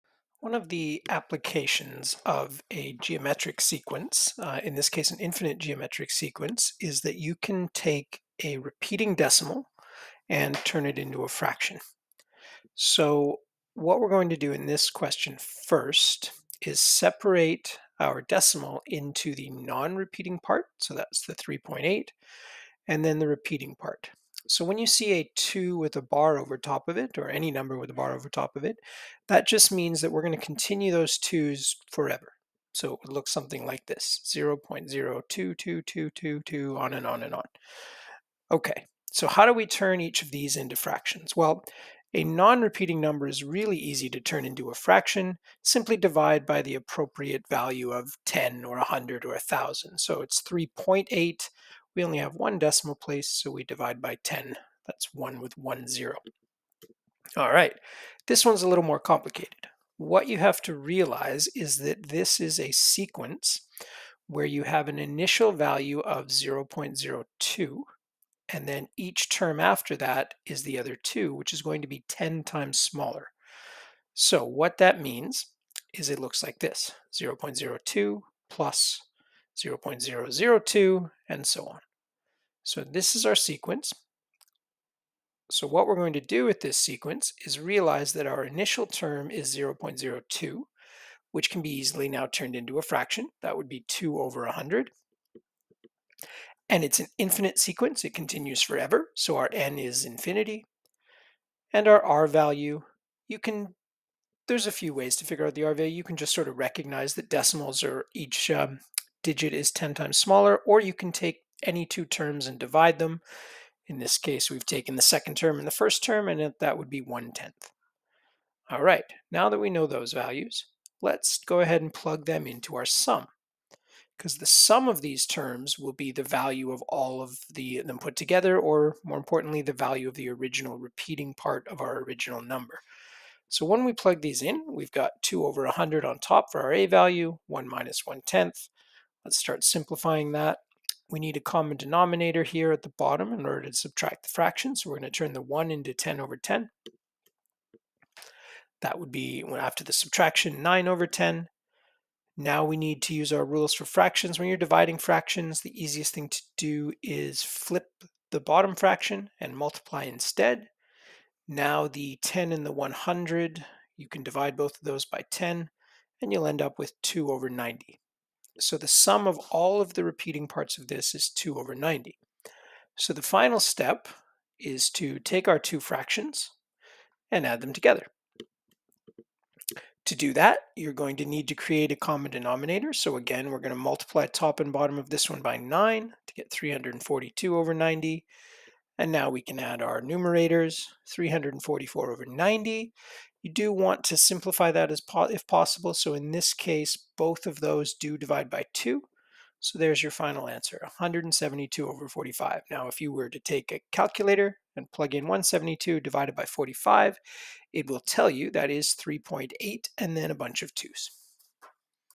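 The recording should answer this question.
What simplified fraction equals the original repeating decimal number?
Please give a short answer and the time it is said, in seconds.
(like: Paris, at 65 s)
172/45, at 200 s.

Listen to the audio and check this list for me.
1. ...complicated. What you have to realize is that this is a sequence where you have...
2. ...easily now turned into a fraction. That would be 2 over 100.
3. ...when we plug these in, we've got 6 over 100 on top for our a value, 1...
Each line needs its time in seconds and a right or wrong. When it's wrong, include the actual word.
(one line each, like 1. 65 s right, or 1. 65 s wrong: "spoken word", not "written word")
1. 58 s right
2. 91 s right
3. 133 s wrong: "2", not "6".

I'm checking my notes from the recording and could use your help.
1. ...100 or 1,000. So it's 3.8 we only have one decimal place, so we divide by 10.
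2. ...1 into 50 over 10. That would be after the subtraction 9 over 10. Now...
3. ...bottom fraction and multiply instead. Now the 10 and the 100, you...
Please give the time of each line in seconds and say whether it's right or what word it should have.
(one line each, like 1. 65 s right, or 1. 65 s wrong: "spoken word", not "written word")
1. 48 s right
2. 145 s wrong: "10", not "50"
3. 158 s right.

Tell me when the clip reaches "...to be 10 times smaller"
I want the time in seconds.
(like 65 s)
71 s.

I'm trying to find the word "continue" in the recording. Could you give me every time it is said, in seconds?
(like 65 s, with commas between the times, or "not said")
30 s, 98 s.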